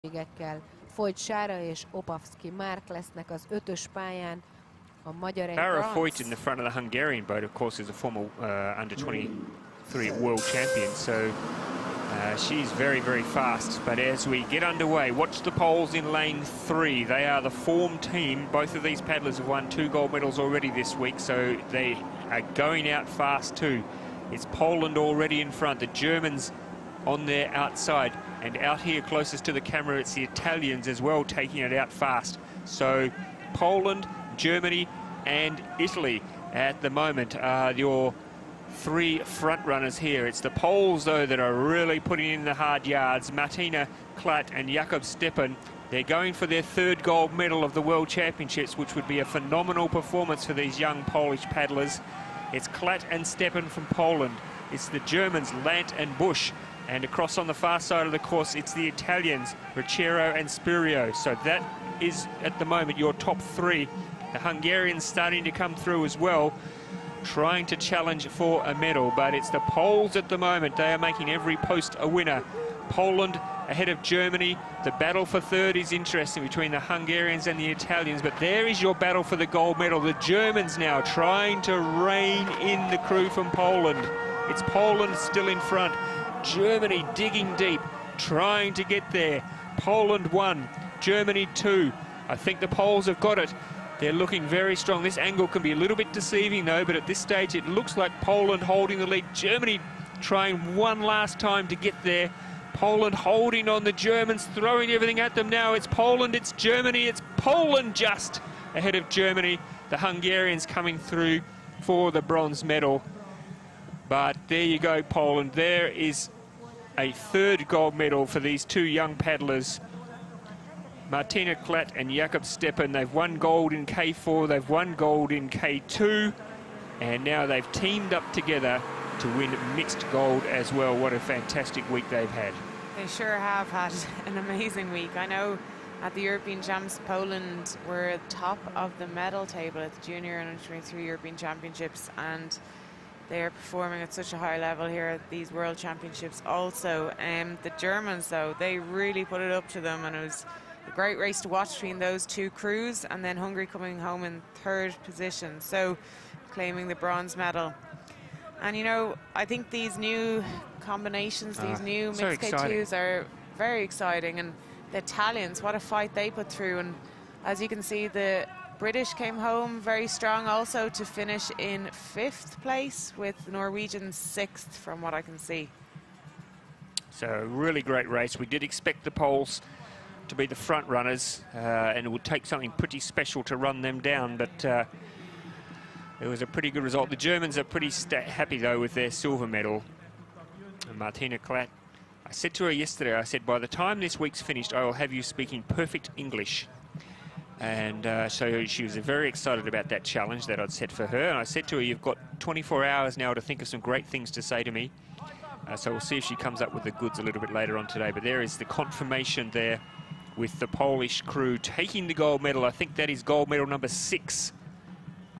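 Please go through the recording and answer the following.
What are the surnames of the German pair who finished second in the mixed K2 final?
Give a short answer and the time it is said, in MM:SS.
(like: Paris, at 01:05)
Lant and Busch, at 00:55.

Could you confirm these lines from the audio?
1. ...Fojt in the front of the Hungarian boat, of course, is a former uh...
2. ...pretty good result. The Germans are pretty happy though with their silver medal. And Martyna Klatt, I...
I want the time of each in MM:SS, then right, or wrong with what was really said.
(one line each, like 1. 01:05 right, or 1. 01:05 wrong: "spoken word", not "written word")
1. 00:05 right
2. 03:06 right.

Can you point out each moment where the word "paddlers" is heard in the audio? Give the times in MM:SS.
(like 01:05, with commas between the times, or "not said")
00:19, 00:51, 01:59.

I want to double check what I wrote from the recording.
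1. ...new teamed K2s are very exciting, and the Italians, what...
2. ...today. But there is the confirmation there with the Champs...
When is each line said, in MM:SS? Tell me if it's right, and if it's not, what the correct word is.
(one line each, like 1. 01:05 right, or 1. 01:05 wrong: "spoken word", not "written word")
1. 02:41 wrong: "mixed", not "teamed"
2. 03:27 wrong: "Polish", not "Champs".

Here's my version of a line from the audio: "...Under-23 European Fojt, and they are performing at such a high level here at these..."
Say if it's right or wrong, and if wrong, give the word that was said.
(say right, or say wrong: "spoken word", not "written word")
wrong: "Championships", not "Fojt".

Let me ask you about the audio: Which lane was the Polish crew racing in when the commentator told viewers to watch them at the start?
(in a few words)
Lane 3.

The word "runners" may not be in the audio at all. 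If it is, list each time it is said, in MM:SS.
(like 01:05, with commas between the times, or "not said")
00:39, 03:00.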